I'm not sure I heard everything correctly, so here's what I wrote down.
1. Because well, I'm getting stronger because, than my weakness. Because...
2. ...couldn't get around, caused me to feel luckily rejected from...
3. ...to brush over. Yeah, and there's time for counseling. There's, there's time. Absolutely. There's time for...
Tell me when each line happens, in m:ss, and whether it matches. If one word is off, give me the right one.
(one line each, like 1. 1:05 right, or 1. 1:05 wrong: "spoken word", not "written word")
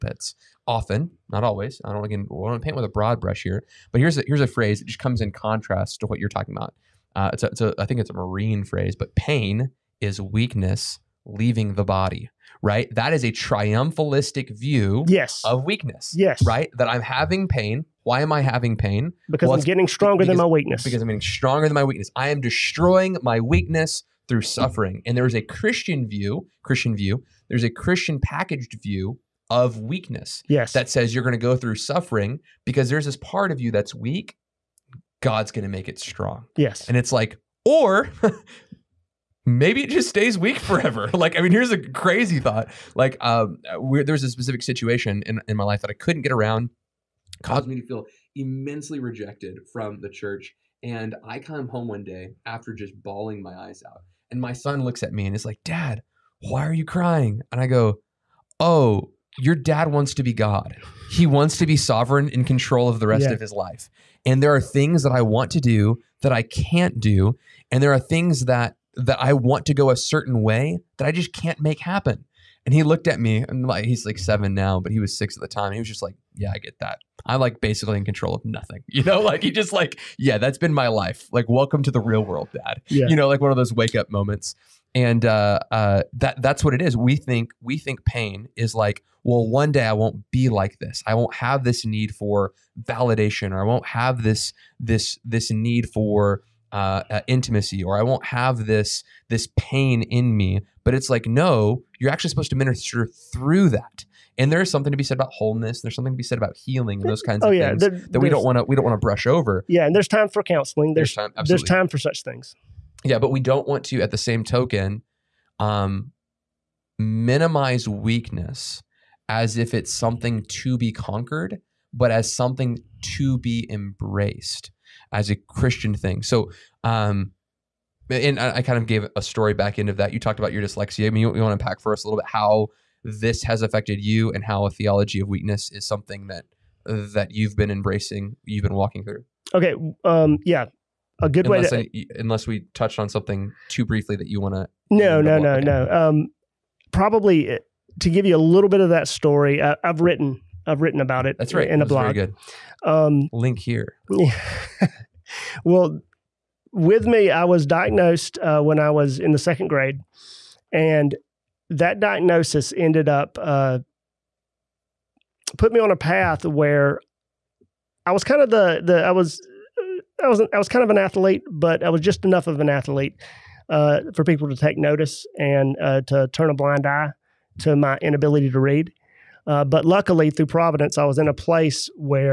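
1. 0:19 right
2. 0:45 wrong: "immensely", not "luckily"
3. 1:48 right.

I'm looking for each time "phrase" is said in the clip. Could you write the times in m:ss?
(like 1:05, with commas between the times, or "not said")
0:04, 0:08.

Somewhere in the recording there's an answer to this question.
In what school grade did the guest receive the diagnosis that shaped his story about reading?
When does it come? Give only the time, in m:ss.
2:39.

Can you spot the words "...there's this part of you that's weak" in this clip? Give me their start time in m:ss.
0:32.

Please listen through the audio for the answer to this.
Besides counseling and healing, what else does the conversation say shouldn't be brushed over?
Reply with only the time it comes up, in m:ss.
1:45.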